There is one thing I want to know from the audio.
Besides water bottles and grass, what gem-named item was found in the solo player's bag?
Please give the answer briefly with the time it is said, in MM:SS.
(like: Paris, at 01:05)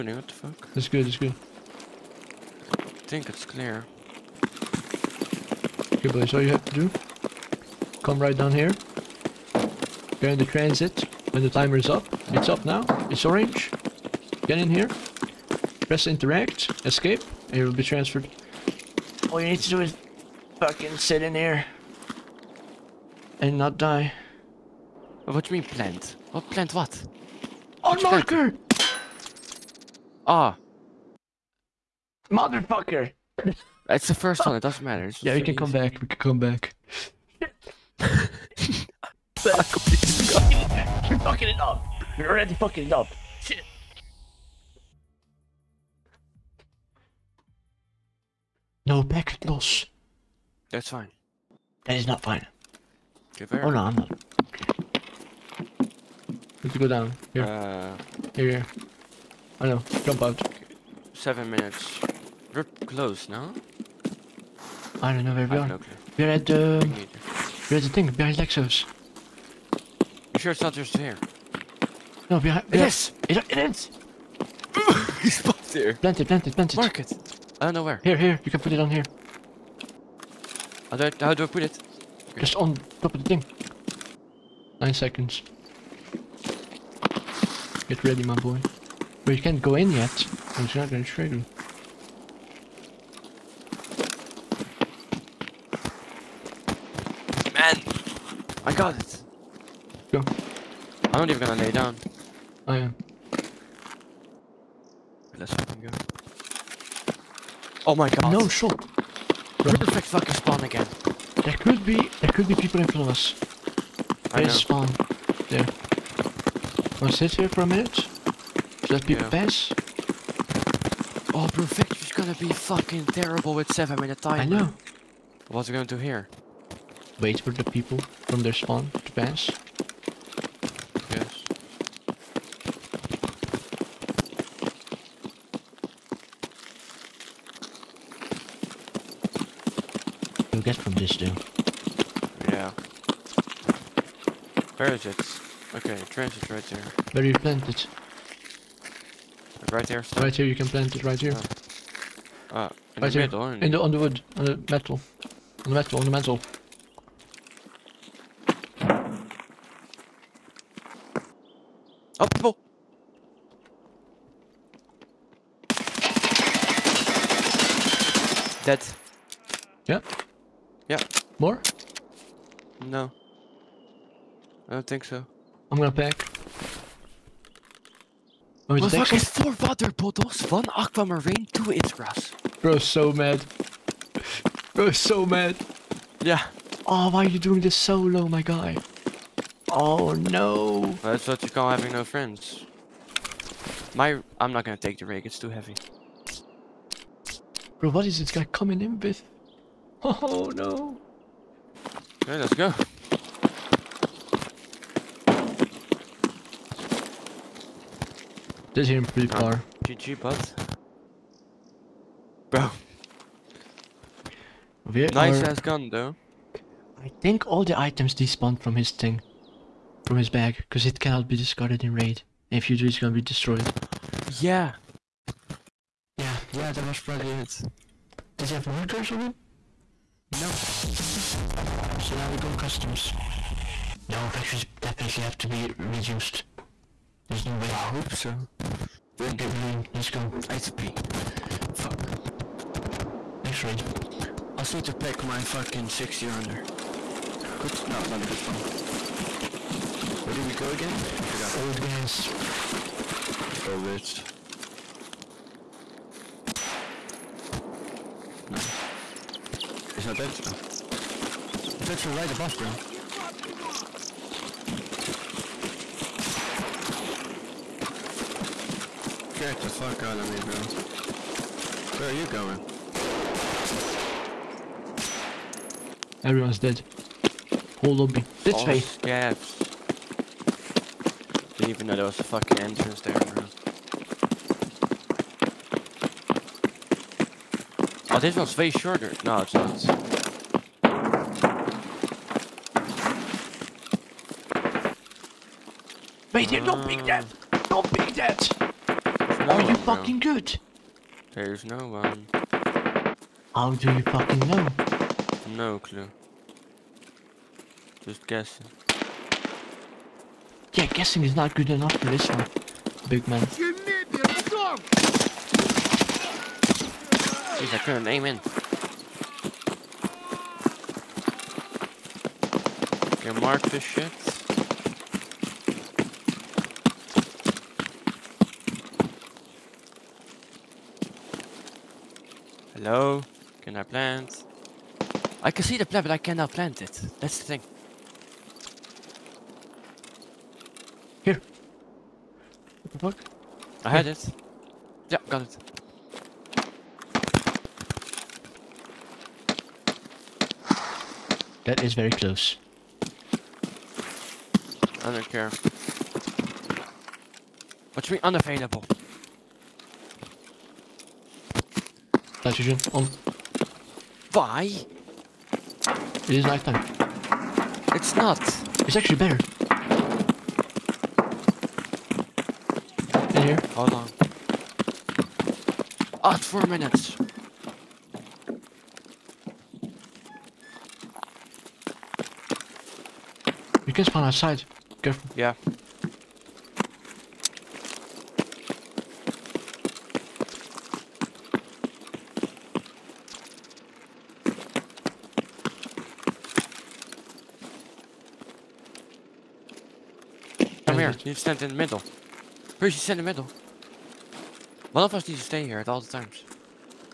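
Aquamarine, at 03:00.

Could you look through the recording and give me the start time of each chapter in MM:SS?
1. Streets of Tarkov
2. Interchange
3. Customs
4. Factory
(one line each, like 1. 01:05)
1. 00:44
2. 01:44
3. 03:53
4. 06:01.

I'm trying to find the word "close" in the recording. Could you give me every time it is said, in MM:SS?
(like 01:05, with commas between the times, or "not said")
01:02, 05:52.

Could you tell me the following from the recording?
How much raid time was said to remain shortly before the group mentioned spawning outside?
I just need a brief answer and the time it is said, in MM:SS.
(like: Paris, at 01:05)
4 minutes, at 06:16.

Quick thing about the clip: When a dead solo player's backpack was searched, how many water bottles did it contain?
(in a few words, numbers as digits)
4.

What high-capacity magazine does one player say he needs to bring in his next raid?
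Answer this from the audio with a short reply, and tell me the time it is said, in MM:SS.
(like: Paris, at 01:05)
60 rounder, at 04:05.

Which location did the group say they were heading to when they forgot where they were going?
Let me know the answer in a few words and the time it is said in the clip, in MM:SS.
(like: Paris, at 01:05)
Old gas, at 04:11.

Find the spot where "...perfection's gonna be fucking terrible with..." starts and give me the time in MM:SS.
02:01.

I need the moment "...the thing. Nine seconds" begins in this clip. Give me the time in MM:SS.
01:23.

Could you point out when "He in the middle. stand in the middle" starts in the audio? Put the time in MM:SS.
06:41.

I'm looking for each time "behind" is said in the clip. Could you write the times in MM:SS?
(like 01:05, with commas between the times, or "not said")
01:08, 01:12.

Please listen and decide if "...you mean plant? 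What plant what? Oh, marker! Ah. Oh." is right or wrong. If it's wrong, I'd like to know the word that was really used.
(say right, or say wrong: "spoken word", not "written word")
right.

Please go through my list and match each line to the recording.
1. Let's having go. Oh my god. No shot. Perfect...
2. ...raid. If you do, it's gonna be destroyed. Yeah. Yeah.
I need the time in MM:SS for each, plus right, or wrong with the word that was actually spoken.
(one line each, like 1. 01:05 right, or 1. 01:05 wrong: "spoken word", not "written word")
1. 01:45 wrong: "fucking", not "having"
2. 03:41 right.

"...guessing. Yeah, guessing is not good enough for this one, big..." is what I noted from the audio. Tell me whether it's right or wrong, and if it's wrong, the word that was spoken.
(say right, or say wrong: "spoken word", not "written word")
right.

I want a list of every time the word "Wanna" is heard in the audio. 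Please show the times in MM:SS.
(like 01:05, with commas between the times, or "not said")
01:57.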